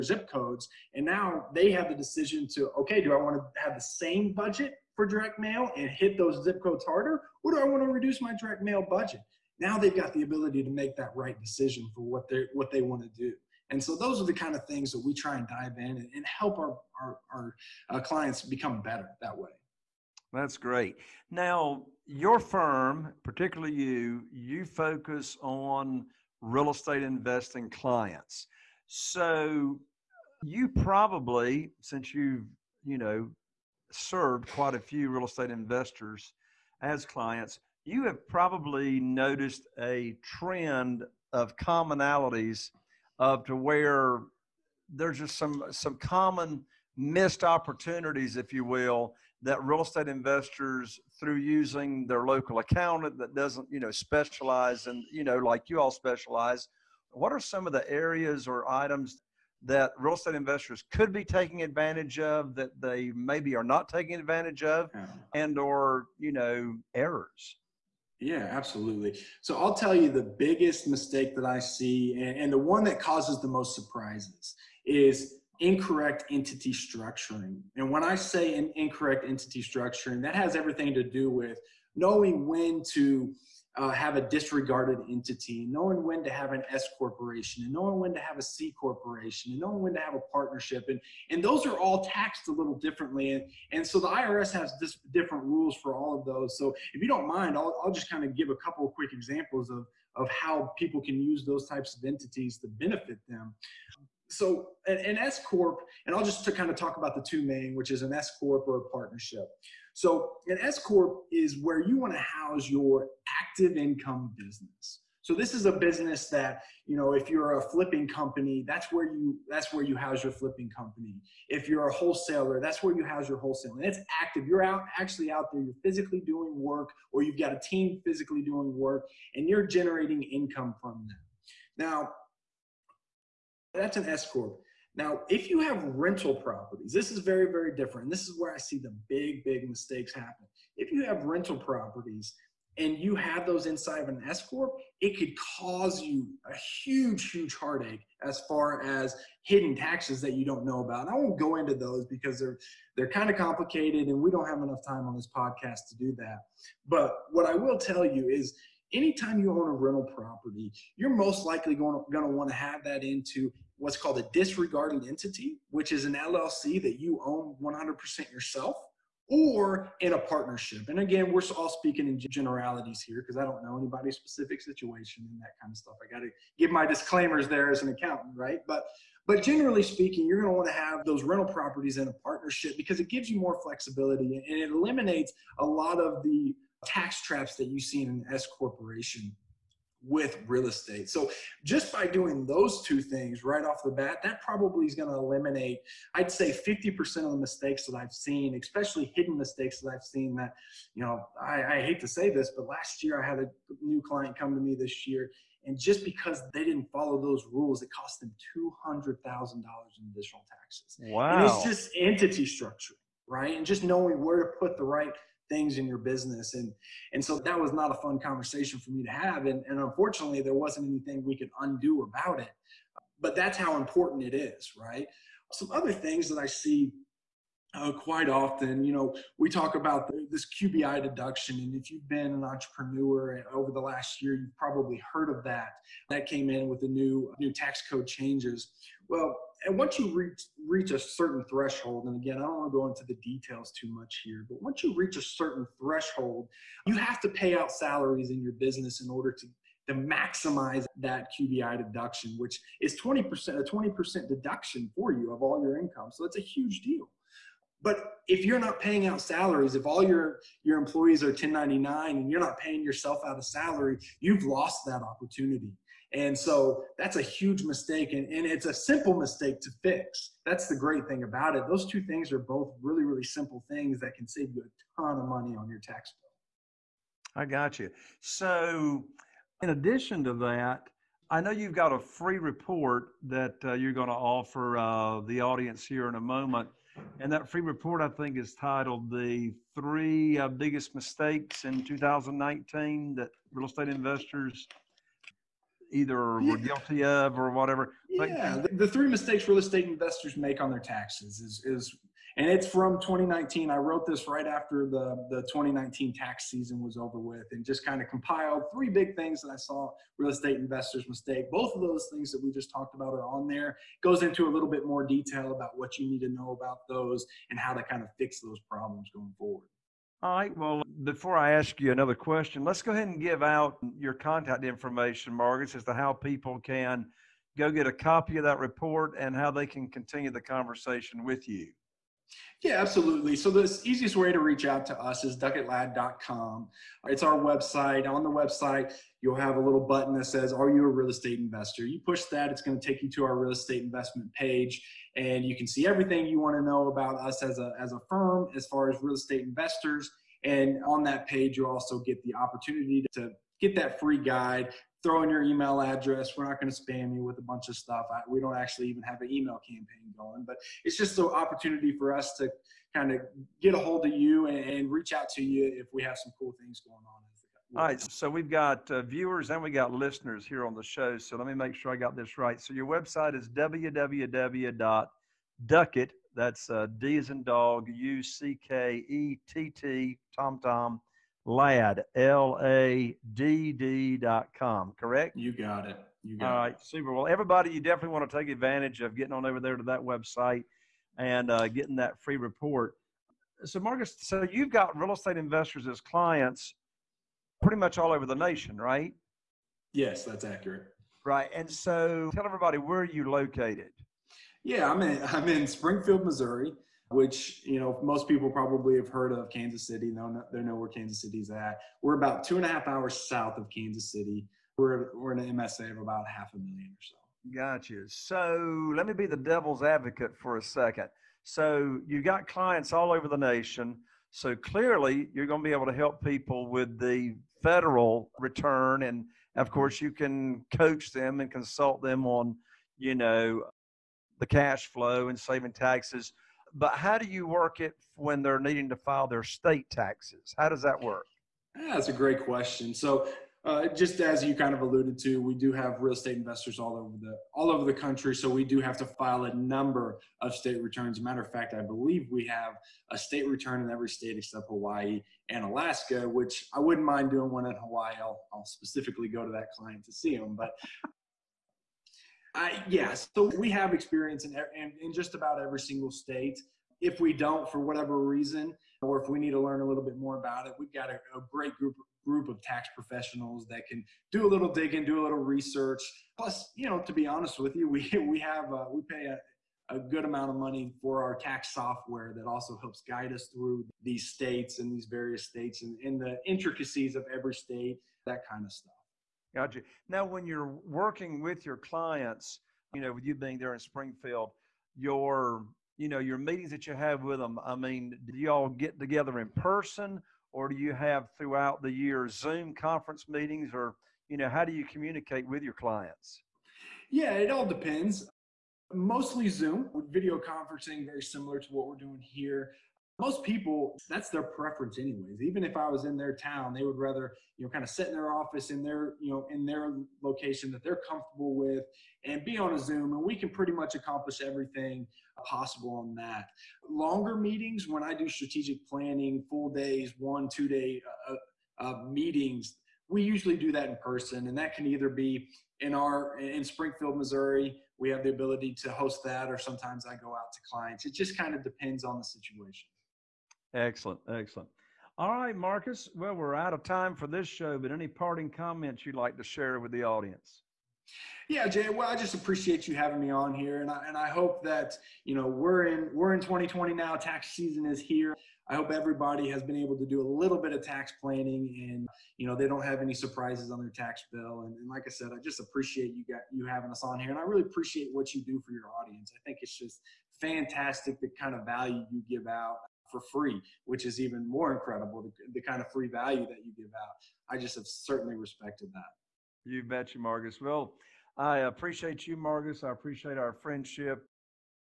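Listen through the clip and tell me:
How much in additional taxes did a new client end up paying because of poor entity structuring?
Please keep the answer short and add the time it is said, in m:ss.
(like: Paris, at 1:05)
$200,000, at 3:28.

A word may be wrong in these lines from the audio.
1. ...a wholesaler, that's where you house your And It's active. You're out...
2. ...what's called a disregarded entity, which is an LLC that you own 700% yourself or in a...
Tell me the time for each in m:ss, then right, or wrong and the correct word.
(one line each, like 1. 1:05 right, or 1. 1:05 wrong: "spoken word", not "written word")
1. 2:01 right
2. 2:43 wrong: "100", not "700".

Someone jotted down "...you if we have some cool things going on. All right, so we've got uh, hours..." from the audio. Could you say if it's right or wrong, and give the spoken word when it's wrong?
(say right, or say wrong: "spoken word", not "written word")
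wrong: "viewers", not "hours".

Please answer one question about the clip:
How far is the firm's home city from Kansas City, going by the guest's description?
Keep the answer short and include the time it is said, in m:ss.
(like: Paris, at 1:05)
two and a half hours, at 6:52.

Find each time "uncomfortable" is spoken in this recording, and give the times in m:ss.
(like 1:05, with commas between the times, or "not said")
not said.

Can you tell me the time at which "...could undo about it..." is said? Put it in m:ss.
3:41.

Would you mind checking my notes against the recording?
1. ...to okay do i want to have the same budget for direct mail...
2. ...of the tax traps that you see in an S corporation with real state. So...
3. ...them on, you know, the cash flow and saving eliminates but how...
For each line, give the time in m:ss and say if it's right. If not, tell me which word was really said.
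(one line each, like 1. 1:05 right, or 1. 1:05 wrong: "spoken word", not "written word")
1. 0:02 right
2. 3:05 wrong: "estate", not "state"
3. 7:12 wrong: "taxes", not "eliminates".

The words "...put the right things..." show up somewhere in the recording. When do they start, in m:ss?
3:34.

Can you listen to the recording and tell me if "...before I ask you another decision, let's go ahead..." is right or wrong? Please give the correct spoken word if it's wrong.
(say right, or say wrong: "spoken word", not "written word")
wrong: "question", not "decision".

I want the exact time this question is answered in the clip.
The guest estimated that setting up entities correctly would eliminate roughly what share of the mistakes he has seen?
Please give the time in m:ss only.
3:16.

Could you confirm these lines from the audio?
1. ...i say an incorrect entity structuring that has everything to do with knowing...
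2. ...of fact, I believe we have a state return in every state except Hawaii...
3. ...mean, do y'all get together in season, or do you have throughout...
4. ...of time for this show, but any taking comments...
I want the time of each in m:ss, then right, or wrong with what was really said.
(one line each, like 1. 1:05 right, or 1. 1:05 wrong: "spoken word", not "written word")
1. 1:18 right
2. 7:31 right
3. 8:17 wrong: "person", not "season"
4. 9:06 wrong: "parting", not "taking".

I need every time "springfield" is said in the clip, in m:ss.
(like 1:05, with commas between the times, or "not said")
6:45, 8:13, 8:56.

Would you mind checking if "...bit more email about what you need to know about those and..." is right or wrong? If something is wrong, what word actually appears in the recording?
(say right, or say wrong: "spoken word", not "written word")
wrong: "detail", not "email".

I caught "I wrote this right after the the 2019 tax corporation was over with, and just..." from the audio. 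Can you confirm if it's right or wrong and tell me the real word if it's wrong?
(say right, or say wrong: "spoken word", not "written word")
wrong: "season", not "corporation".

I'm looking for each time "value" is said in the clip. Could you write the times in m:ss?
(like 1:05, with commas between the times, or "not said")
9:31, 9:36.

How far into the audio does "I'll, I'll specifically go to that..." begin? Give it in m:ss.
7:38.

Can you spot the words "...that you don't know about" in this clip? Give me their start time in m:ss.
2:30.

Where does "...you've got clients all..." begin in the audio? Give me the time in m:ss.
7:02.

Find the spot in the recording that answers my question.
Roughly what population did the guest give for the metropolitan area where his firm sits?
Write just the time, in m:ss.
6:56.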